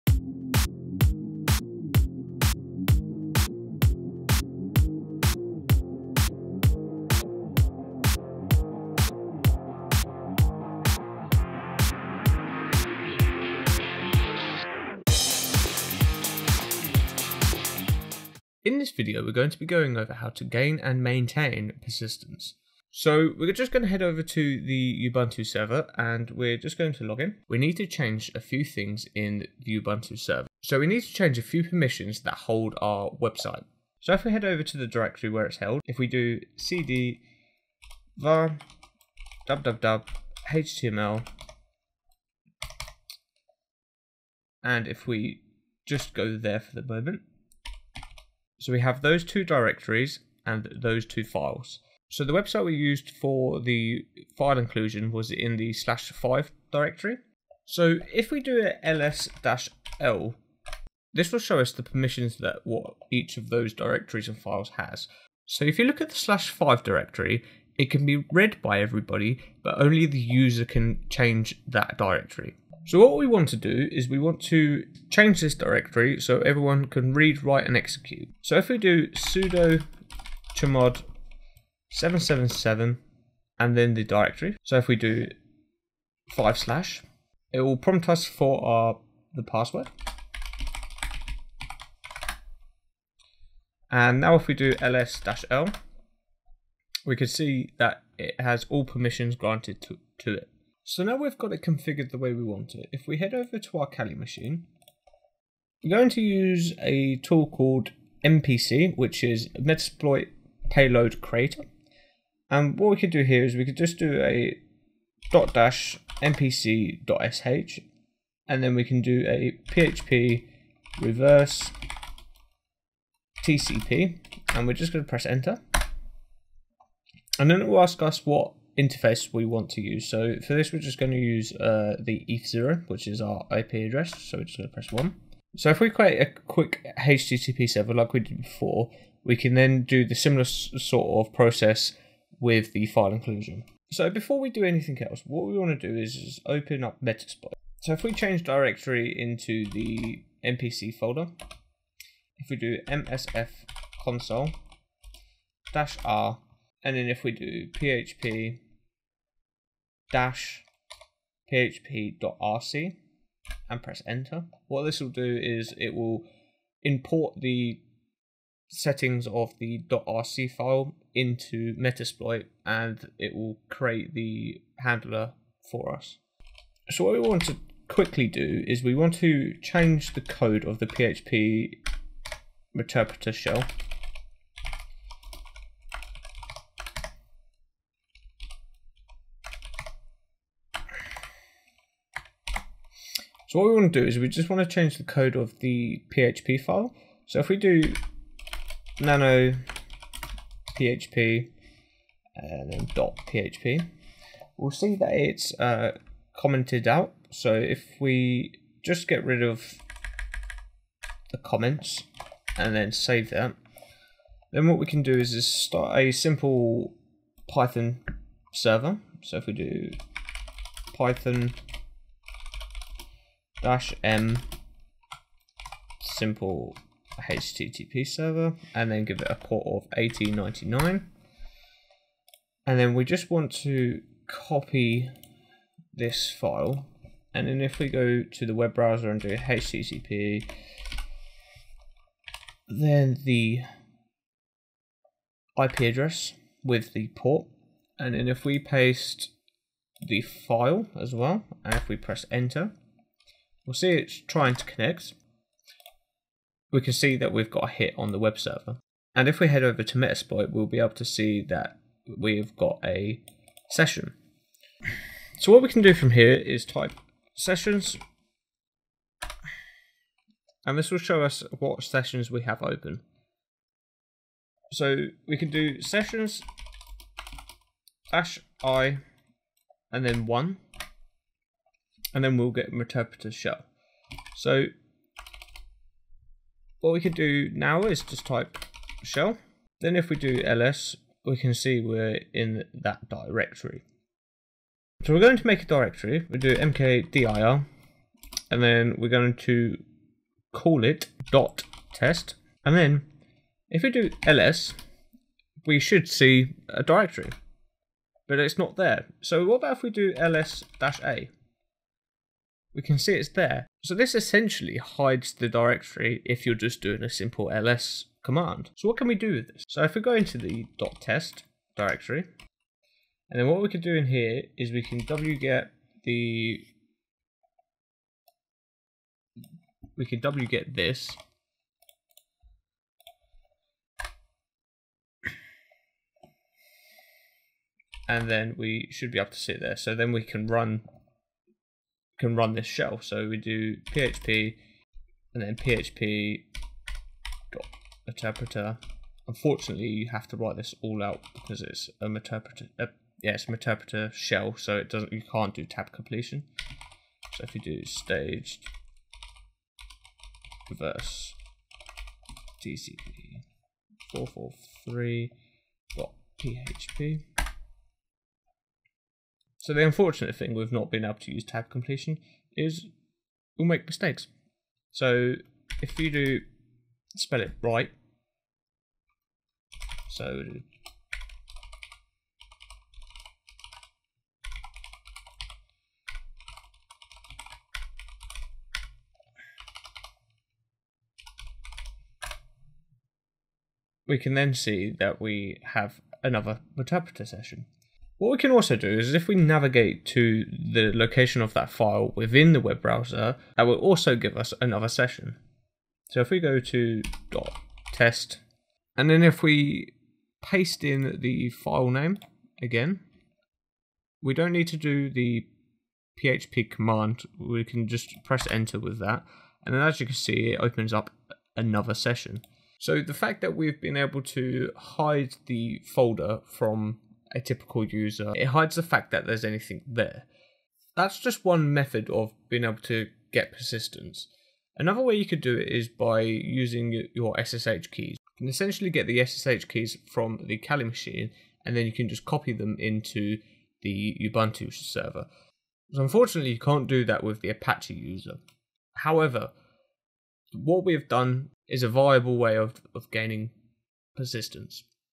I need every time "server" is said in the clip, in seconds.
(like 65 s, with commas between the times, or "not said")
25 s, 30 s, 137 s, 218 s, 228 s, 258 s, 444 s.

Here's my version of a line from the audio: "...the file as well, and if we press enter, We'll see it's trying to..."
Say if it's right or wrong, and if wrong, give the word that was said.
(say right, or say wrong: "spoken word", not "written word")
right.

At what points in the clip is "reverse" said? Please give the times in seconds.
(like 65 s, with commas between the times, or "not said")
120 s, 360 s.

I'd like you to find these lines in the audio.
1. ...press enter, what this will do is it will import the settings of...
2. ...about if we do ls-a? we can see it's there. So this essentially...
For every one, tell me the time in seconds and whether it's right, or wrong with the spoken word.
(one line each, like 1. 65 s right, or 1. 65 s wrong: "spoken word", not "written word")
1. 163 s right
2. 309 s right.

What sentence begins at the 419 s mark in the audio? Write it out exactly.
And then as you can see, it opens up another session.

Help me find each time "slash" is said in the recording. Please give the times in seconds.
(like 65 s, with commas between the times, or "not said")
55 s, 66 s, 86 s.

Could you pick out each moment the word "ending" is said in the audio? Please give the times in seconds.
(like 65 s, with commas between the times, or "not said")
not said.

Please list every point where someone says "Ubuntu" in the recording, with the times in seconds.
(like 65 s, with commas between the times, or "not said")
25 s, 29 s, 444 s.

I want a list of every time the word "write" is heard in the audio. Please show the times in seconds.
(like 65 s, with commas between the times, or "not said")
77 s, 350 s.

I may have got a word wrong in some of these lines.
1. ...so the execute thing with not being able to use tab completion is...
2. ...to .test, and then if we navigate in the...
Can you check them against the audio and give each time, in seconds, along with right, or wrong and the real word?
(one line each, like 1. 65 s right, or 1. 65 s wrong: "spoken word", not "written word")
1. 369 s wrong: "unfortunate", not "execute"
2. 406 s wrong: "paste", not "navigate".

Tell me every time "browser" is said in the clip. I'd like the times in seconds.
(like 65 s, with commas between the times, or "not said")
238 s, 402 s.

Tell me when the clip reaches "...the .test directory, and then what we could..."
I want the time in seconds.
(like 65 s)
320 s.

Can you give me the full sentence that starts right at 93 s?
And now if we do ls-l, we can see that it has all permissions granted to, to it.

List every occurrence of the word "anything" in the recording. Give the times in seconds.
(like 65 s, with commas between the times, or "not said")
144 s, 429 s.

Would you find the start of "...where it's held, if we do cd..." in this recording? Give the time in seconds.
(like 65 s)
35 s.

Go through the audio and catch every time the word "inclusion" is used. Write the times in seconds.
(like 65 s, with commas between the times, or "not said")
54 s, 143 s.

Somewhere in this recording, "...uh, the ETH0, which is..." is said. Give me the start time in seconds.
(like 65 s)
131 s.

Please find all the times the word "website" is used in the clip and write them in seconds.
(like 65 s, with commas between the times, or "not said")
33 s, 52 s.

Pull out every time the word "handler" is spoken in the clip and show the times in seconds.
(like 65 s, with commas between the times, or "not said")
174 s.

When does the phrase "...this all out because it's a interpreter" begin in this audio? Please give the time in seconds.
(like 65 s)
350 s.